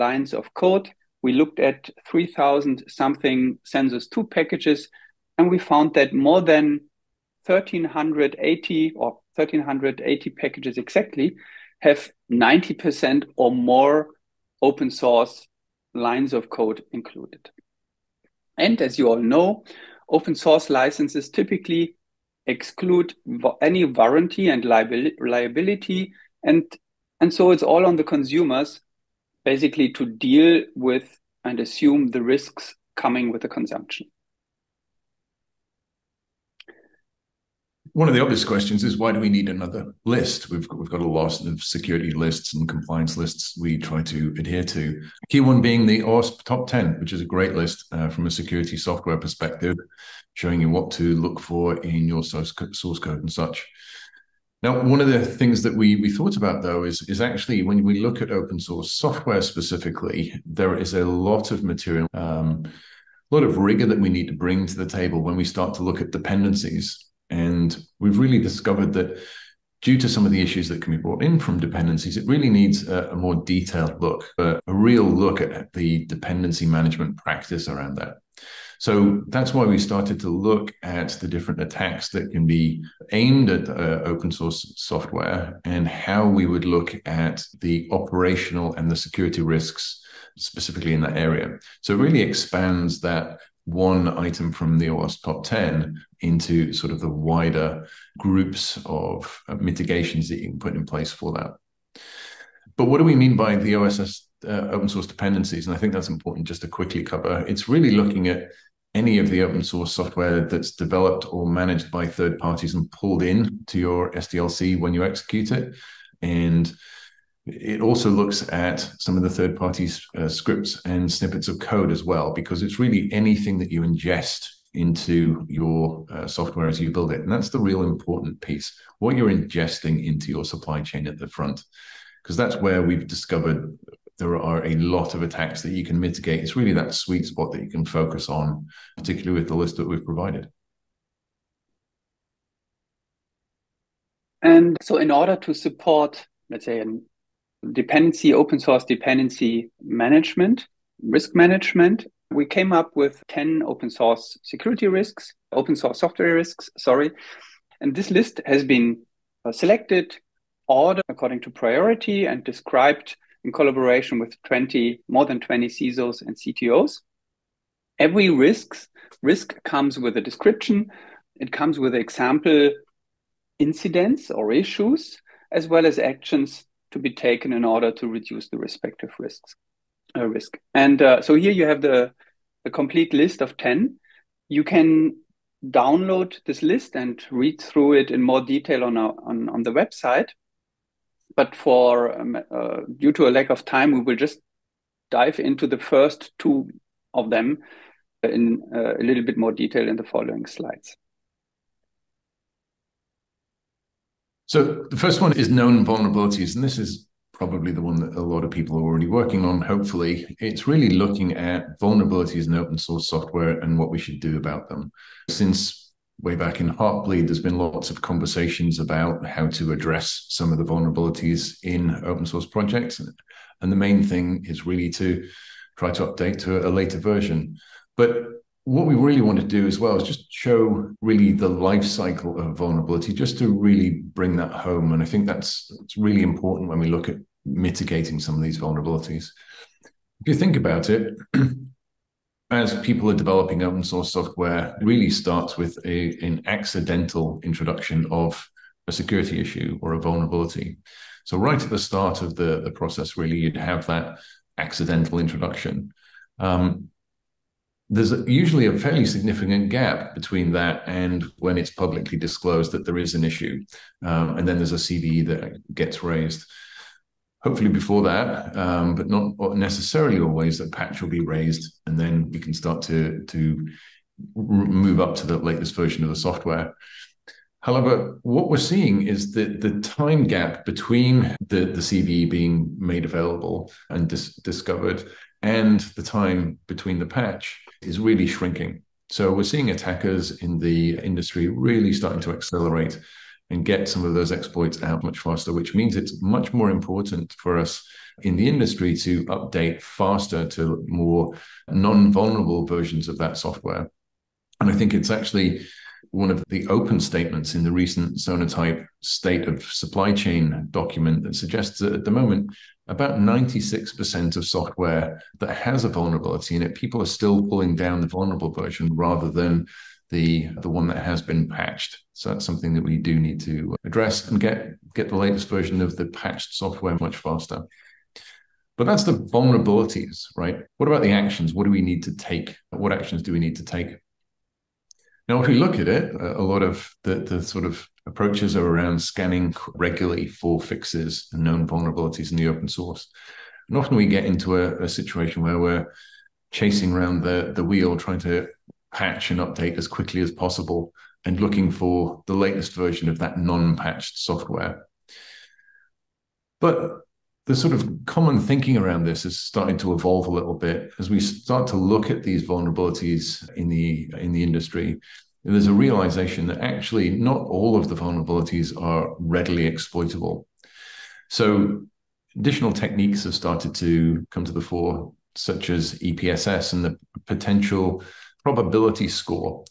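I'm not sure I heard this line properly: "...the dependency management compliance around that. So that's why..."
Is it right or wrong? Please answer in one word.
wrong.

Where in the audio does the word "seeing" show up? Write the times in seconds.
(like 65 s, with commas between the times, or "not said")
278 s, 289 s.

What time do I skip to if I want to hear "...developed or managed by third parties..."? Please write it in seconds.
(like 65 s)
110 s.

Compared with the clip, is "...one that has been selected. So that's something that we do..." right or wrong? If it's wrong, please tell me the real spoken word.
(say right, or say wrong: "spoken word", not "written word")
wrong: "patched", not "selected".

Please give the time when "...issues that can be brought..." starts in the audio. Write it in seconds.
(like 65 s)
70 s.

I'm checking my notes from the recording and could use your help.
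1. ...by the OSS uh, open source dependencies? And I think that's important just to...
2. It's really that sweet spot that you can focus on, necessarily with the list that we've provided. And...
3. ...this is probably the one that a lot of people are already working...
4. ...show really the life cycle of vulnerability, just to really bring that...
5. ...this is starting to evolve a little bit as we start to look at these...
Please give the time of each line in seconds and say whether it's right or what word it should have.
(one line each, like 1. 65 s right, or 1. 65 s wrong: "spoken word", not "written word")
1. 103 s right
2. 136 s wrong: "particularly", not "necessarily"
3. 206 s right
4. 230 s right
5. 359 s right.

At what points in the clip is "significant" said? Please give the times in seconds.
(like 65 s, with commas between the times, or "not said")
259 s.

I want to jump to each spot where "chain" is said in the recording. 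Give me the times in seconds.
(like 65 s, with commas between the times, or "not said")
130 s, 310 s.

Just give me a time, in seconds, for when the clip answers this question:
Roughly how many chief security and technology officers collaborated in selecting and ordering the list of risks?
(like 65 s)
165 s.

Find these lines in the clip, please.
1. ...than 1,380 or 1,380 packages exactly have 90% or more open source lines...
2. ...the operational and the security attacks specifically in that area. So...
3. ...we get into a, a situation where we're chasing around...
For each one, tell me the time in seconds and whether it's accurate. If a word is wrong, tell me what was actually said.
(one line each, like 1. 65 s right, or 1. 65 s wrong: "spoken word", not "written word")
1. 6 s right
2. 87 s wrong: "risks", not "attacks"
3. 343 s right.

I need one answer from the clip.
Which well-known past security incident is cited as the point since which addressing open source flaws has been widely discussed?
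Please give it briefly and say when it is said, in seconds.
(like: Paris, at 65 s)
Heartbleed, at 216 s.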